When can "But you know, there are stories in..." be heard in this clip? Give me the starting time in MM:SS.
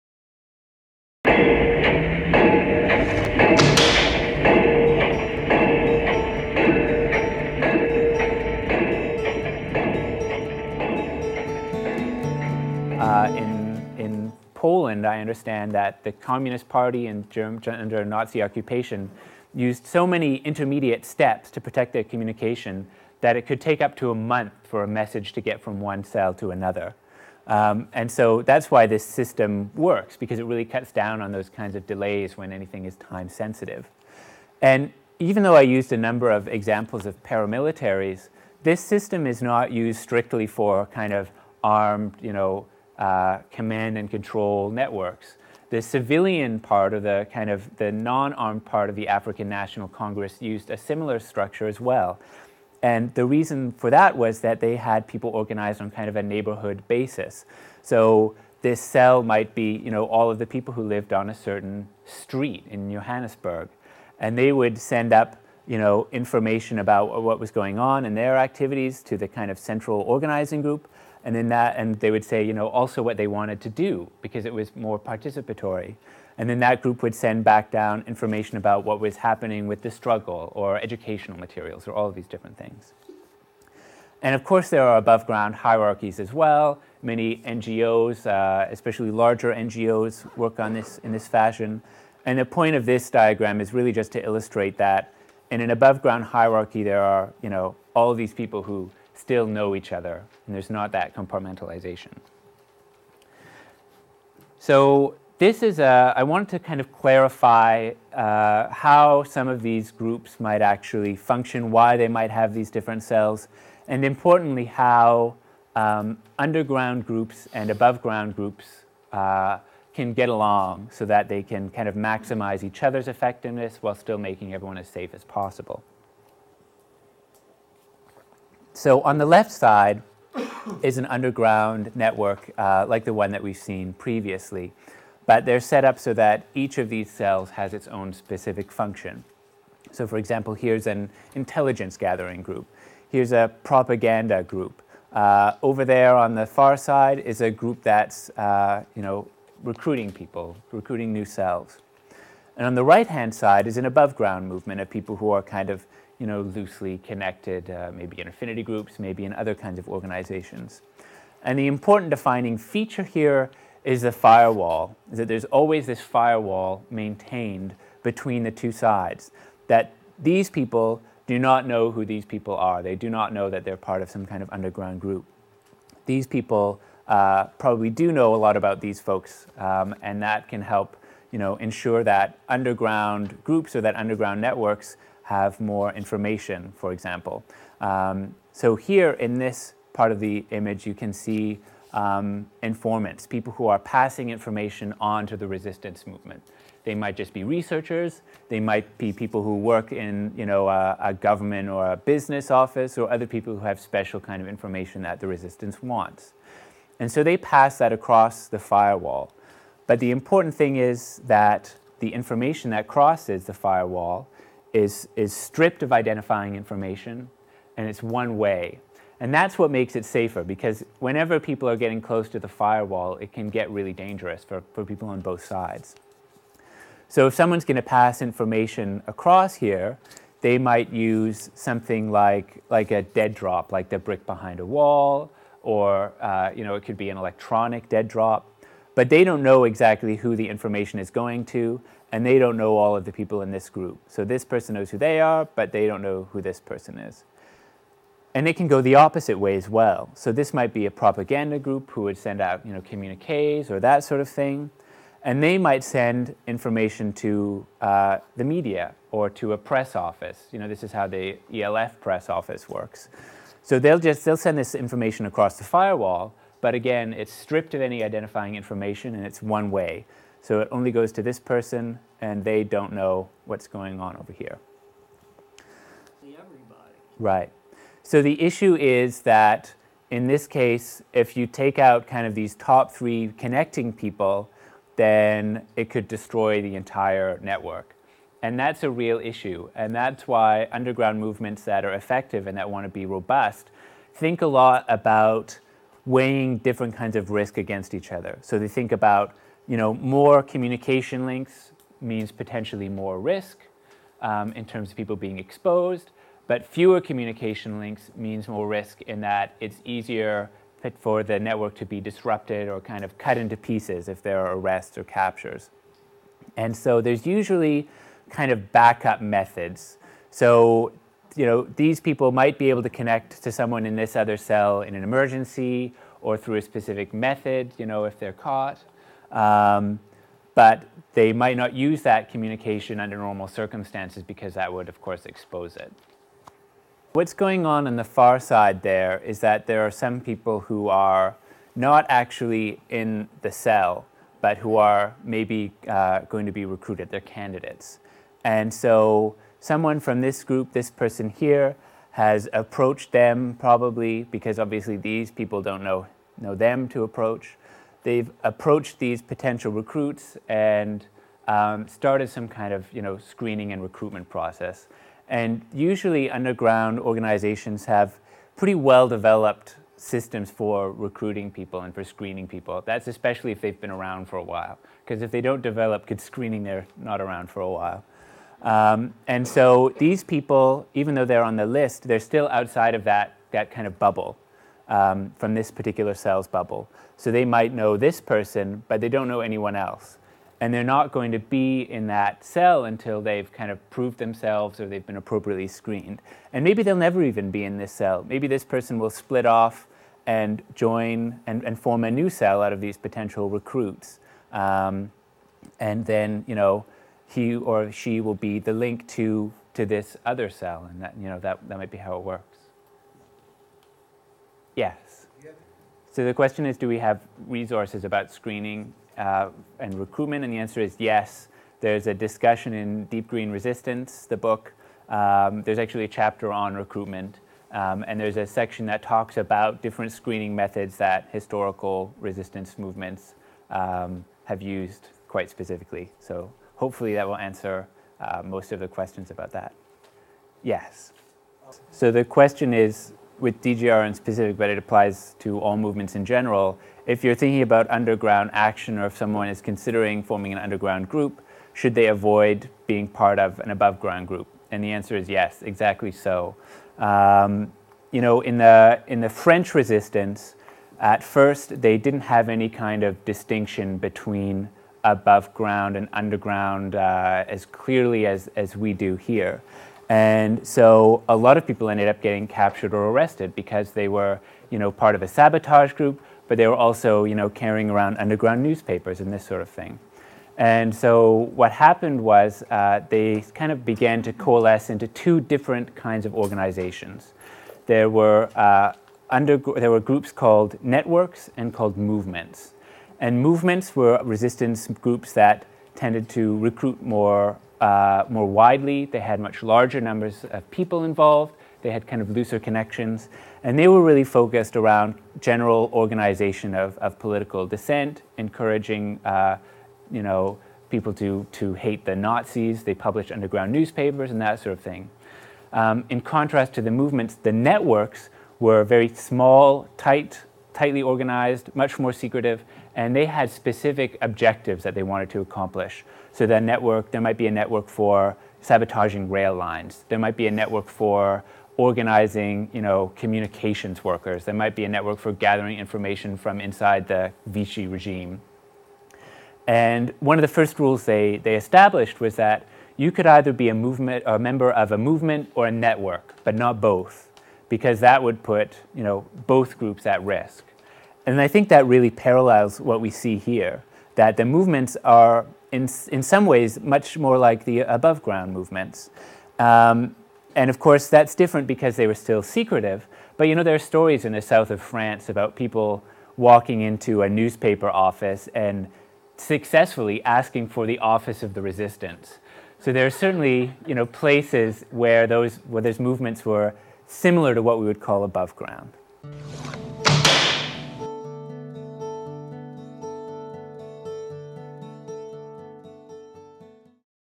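09:23.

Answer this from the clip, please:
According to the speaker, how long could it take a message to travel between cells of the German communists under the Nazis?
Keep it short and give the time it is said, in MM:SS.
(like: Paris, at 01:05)
a month, at 00:24.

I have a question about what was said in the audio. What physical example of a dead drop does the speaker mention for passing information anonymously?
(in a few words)
brick behind a wall.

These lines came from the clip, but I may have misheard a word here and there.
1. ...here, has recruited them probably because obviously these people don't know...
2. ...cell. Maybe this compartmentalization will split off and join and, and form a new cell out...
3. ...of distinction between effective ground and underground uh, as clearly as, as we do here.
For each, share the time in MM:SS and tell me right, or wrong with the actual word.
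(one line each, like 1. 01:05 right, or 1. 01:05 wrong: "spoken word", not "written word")
1. 05:51 wrong: "approached", not "recruited"
2. 06:37 wrong: "person", not "compartmentalization"
3. 07:43 wrong: "above", not "effective".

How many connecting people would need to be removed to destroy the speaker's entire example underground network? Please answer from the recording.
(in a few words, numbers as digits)
3.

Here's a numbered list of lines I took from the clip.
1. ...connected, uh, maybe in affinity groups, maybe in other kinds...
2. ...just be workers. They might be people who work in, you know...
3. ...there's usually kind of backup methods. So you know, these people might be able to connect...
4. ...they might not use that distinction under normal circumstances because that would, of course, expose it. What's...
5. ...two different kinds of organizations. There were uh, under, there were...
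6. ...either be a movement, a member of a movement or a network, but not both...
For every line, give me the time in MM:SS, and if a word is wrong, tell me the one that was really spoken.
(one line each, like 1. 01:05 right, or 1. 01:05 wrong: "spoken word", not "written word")
1. 02:36 right
2. 03:17 wrong: "researchers", not "workers"
3. 05:17 right
4. 05:31 wrong: "communication", not "distinction"
5. 08:05 right
6. 09:03 right.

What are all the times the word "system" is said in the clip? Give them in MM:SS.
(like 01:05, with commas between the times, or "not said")
00:29, 00:38, 06:09.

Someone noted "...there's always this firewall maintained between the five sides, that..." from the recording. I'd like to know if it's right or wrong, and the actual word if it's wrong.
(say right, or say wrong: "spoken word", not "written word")
wrong: "two", not "five".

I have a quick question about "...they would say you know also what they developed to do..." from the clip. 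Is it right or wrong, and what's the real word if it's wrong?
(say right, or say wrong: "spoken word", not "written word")
wrong: "wanted", not "developed".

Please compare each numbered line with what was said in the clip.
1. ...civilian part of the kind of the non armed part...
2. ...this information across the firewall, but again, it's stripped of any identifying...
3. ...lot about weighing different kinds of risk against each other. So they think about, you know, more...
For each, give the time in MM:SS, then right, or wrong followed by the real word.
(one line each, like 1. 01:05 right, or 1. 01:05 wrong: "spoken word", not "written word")
1. 00:45 right
2. 04:24 right
3. 04:54 right.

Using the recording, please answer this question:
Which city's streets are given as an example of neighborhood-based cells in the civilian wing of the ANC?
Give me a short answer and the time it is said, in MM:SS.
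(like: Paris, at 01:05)
Johannesburg, at 01:02.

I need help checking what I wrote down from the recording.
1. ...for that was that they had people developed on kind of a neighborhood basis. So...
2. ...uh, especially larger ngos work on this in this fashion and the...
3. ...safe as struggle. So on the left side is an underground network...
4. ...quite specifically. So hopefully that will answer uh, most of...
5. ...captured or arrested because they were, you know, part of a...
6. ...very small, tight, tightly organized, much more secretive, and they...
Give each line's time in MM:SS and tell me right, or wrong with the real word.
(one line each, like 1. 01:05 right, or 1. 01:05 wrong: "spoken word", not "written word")
1. 00:53 wrong: "organized", not "developed"
2. 01:28 right
3. 02:04 wrong: "possible", not "struggle"
4. 07:15 right
5. 07:52 right
6. 08:38 right.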